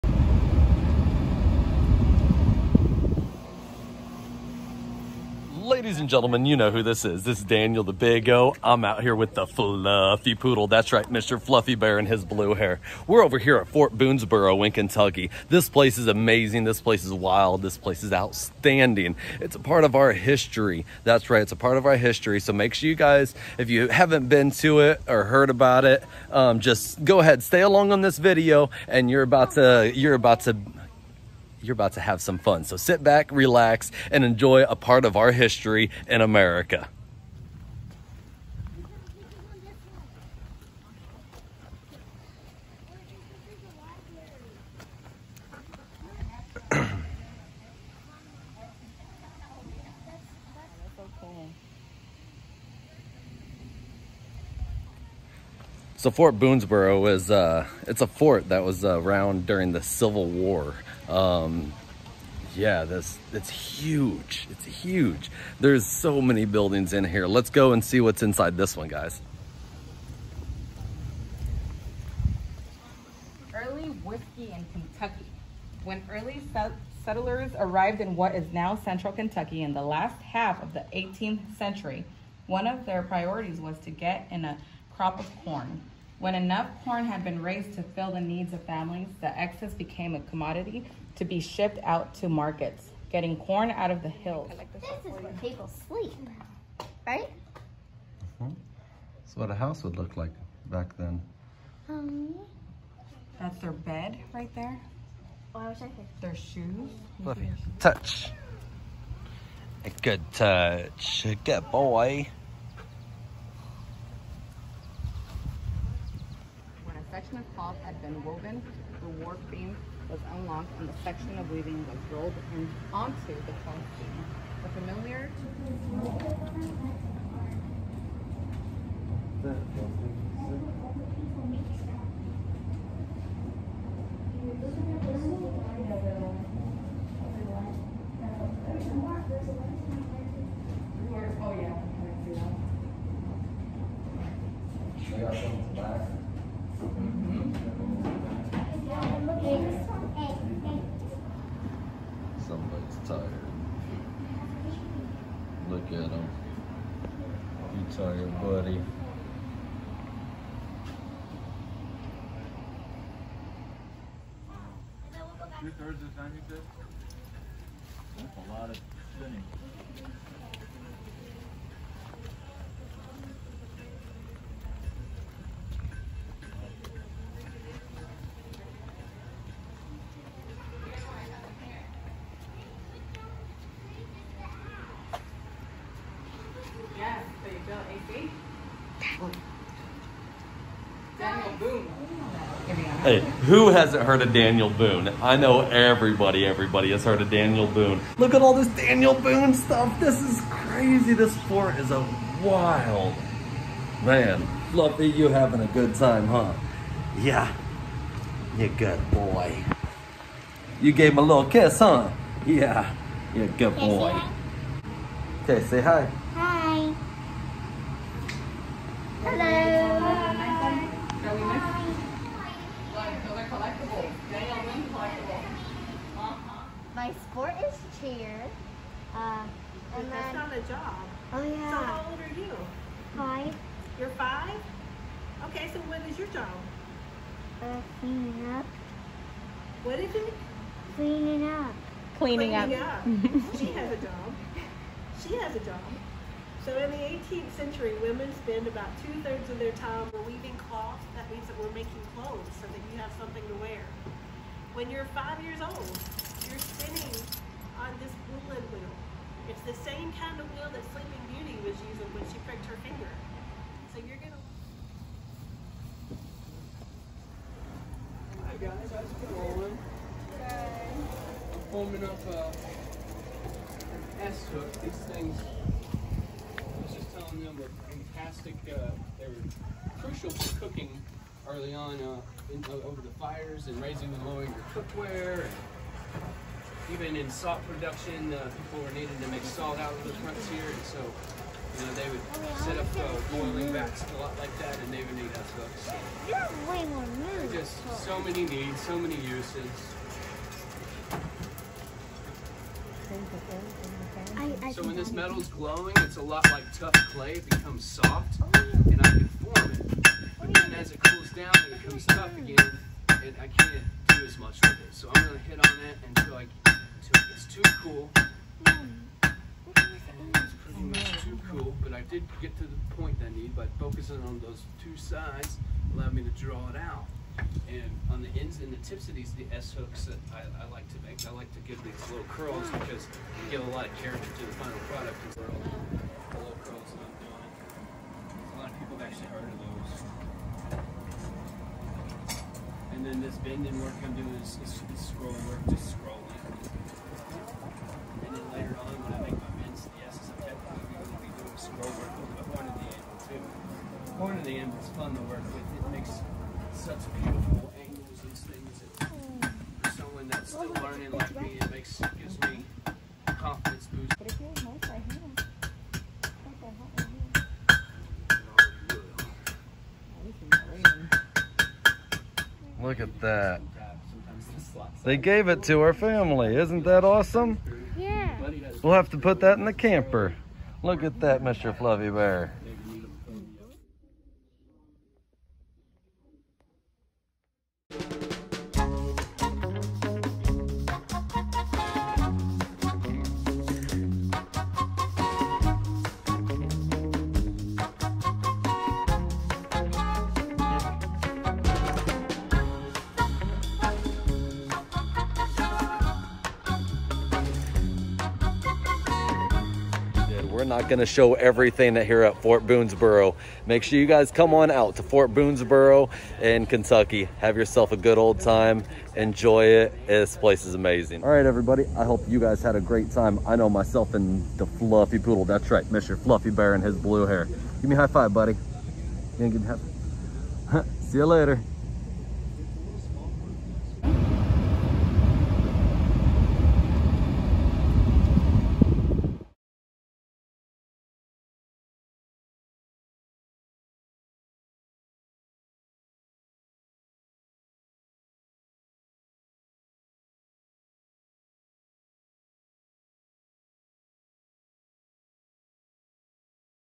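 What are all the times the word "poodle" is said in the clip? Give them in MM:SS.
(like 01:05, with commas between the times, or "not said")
00:10, 07:05.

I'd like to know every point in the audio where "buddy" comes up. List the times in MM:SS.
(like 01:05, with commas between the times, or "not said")
02:38, 07:08.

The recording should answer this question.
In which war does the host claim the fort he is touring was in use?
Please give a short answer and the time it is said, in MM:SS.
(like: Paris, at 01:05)
Civil War, at 00:59.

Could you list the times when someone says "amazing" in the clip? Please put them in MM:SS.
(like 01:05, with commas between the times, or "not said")
00:16, 07:00.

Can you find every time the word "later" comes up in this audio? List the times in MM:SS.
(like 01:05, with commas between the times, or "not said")
05:48, 07:11.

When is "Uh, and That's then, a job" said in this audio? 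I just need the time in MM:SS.
03:49.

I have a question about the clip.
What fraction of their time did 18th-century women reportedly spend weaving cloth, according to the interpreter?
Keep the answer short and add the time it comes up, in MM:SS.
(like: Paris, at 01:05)
two-thirds, at 04:09.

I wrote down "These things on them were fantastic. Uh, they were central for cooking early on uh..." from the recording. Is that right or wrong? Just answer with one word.
wrong.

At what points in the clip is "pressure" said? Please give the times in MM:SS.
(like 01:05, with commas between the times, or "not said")
not said.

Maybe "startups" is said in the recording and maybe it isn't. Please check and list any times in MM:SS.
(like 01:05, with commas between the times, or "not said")
not said.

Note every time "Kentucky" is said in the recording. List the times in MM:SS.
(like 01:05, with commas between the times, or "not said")
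00:14, 01:14, 01:19, 06:56.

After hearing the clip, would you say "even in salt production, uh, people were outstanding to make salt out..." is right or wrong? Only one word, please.
wrong.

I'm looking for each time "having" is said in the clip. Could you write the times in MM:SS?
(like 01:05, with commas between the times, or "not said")
03:25.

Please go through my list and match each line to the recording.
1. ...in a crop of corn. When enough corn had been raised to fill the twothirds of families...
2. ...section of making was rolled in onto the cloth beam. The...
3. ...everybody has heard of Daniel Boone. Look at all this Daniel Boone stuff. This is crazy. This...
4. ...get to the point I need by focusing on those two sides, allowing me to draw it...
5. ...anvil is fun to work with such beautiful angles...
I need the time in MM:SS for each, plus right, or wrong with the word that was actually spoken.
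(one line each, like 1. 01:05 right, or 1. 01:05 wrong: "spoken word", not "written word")
1. 01:24 wrong: "needs", not "twothirds"
2. 02:01 wrong: "weaving", not "making"
3. 03:16 right
4. 05:22 right
5. 05:54 right.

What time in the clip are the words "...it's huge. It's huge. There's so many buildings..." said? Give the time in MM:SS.
01:03.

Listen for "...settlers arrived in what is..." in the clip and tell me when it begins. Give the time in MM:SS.
01:17.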